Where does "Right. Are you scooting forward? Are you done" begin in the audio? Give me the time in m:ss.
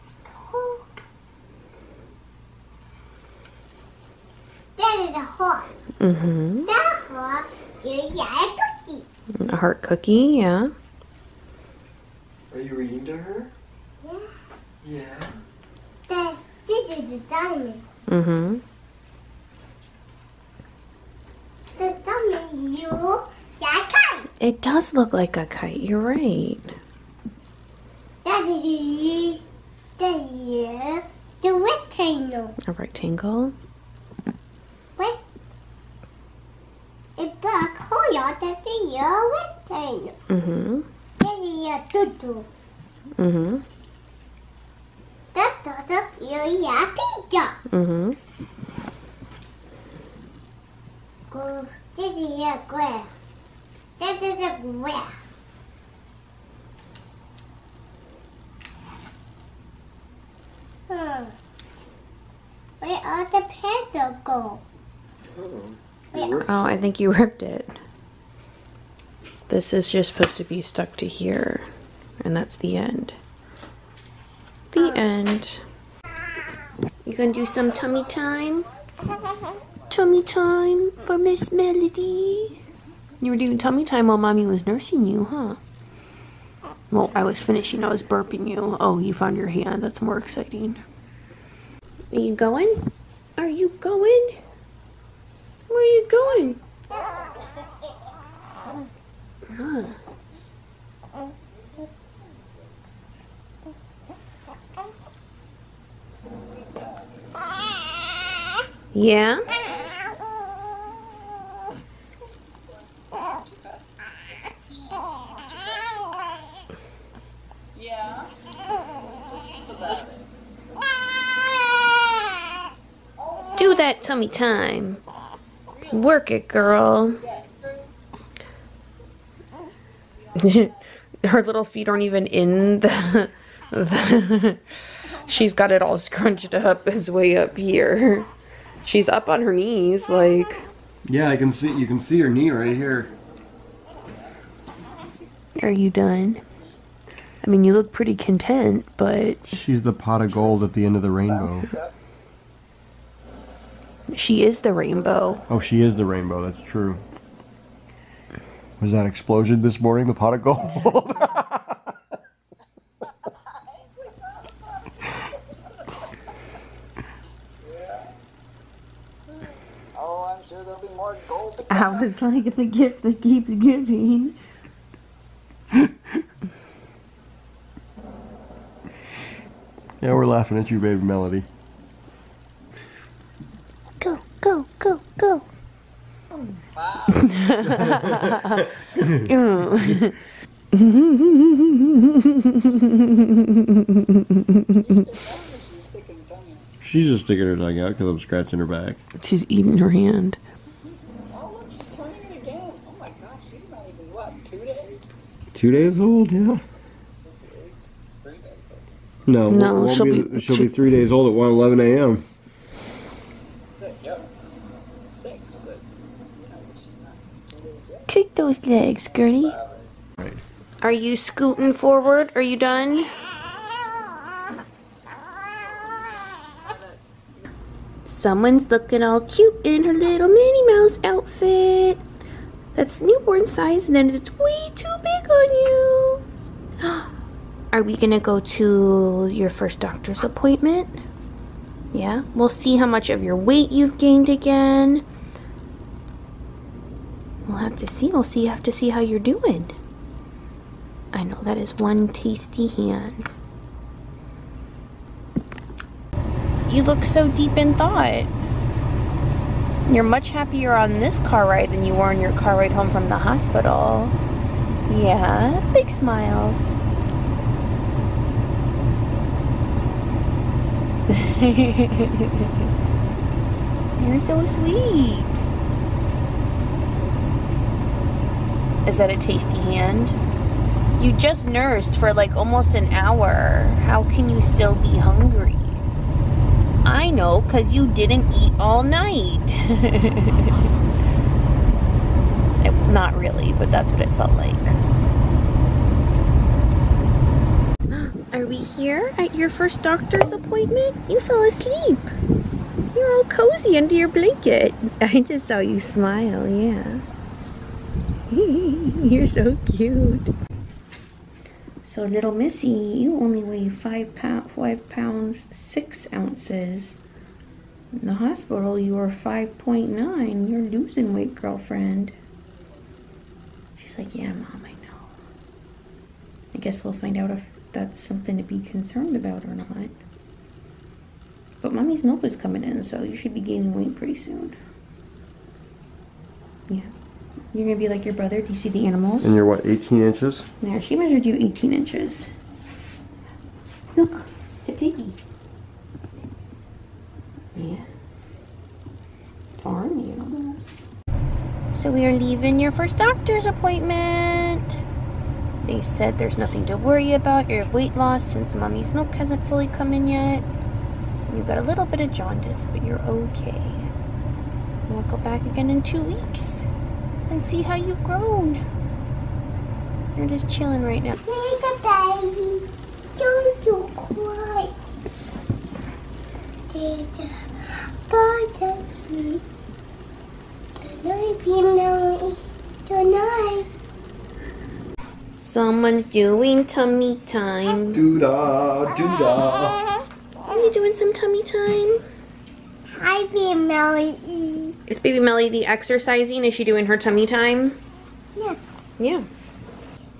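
3:40.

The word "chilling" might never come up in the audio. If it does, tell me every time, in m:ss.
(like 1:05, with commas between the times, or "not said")
6:10.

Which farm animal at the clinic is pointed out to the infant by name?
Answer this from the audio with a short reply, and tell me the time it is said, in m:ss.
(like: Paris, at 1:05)
piggy, at 5:44.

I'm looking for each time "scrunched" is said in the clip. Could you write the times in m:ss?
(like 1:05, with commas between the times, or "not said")
2:15.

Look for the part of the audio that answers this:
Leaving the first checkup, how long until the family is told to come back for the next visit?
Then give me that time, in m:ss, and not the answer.
6:05.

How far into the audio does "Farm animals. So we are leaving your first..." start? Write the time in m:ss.
5:49.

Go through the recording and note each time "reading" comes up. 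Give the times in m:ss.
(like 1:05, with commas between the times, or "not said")
0:12.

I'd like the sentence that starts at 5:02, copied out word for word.
You're all cozy under your blanket.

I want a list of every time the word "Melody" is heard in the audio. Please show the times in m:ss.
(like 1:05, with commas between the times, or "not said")
1:21, 3:01, 6:35.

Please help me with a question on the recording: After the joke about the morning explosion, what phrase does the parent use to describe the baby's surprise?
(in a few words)
the gift that keeps giving.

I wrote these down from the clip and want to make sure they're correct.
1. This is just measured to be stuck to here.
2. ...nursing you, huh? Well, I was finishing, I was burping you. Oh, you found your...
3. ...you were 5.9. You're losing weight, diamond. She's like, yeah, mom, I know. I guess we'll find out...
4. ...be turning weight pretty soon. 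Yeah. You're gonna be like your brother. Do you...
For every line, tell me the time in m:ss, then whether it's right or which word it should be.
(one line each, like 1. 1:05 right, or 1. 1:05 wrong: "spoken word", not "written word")
1. 1:09 wrong: "supposed", not "measured"
2. 1:24 right
3. 5:18 wrong: "girlfriend", not "diamond"
4. 5:33 wrong: "gaining", not "turning".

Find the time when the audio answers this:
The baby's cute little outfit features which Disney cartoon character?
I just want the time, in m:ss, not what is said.
3:50.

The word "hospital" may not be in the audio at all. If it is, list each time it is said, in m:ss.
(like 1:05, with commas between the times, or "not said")
4:23, 5:18.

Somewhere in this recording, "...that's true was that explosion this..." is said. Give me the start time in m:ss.
2:36.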